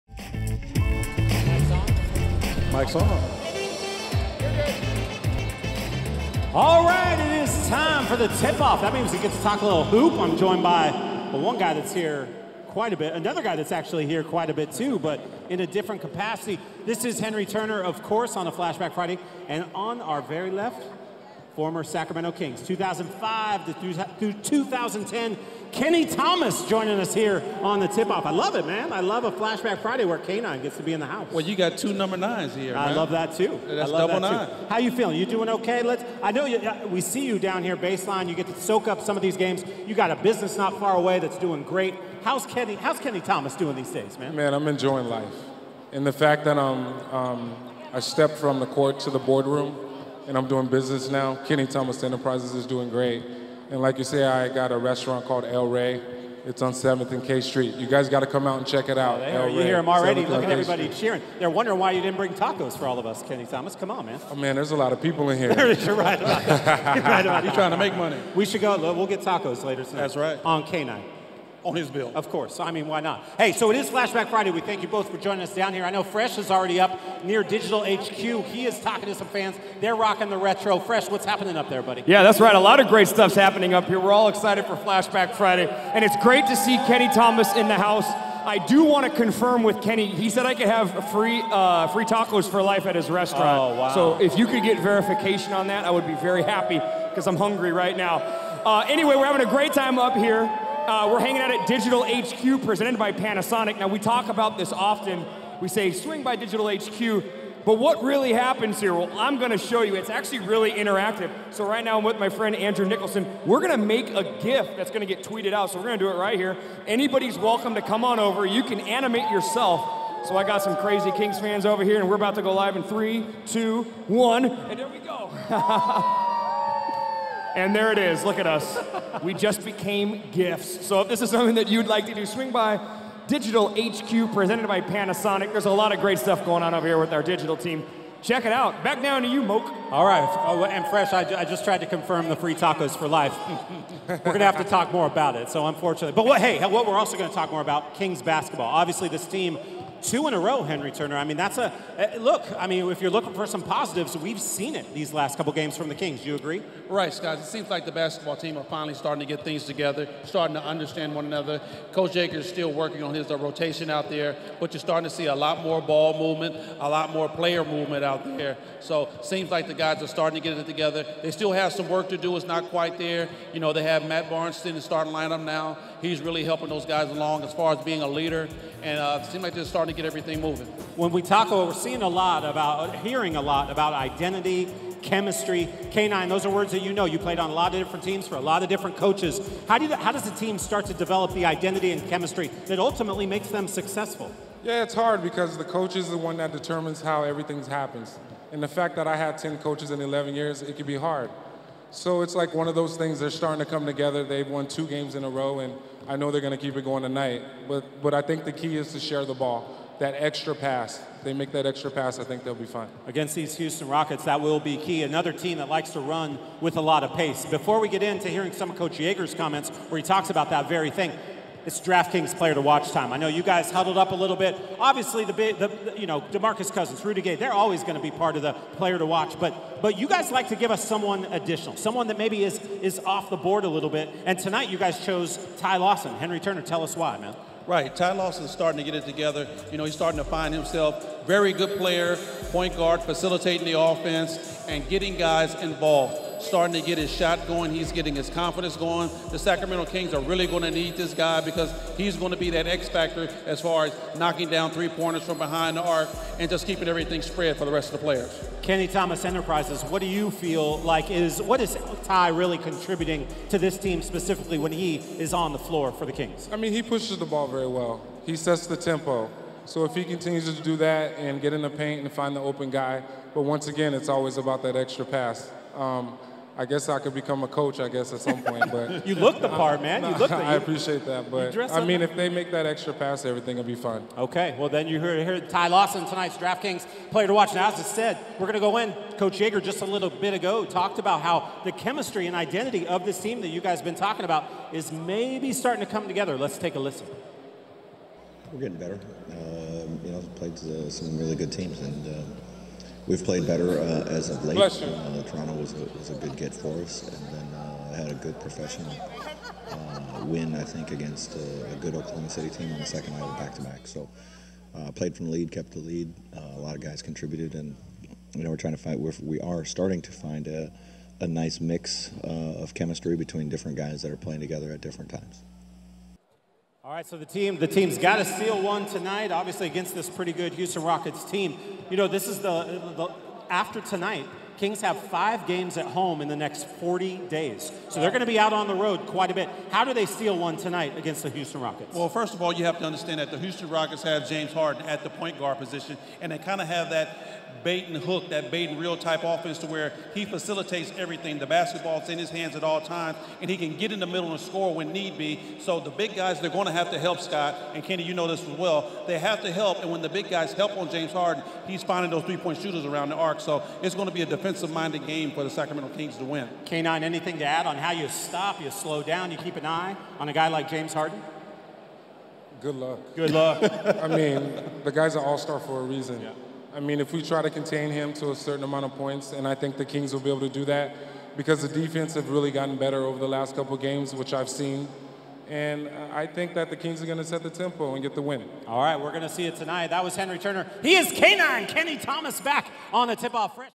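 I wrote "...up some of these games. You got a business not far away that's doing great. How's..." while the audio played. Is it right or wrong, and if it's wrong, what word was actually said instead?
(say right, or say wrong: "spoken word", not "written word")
right.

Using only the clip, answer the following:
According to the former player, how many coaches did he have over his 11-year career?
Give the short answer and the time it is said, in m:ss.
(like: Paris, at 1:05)
10, at 3:19.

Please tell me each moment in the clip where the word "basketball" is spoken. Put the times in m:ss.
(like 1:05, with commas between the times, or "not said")
2:28, 2:37, 5:51.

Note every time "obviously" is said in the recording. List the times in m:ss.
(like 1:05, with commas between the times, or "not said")
2:28, 3:44, 5:29.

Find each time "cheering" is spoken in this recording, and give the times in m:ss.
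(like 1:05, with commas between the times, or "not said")
1:00.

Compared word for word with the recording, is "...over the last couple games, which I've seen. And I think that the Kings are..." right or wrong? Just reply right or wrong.
right.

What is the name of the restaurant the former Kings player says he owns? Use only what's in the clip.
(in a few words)
El Rey.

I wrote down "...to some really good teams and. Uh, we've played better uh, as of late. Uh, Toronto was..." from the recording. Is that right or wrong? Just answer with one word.
right.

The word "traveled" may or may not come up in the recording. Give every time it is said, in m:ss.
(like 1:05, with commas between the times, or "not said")
not said.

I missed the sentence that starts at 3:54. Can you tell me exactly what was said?
And tonight, you guys chose Ty Lawson, Henry Turner.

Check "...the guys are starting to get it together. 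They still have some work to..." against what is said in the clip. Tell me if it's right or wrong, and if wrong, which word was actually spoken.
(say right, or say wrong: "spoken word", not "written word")
right.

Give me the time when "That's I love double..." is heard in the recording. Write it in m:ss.
0:33.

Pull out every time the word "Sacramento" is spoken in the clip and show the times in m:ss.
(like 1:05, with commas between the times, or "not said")
0:21, 4:09, 6:05.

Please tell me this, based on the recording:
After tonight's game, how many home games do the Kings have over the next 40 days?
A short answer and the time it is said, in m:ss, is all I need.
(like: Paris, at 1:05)
5, at 5:34.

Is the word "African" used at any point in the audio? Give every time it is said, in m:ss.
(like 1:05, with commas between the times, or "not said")
not said.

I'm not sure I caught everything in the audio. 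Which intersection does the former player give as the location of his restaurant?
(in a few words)
7th and K Street.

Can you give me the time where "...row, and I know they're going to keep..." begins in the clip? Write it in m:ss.
3:25.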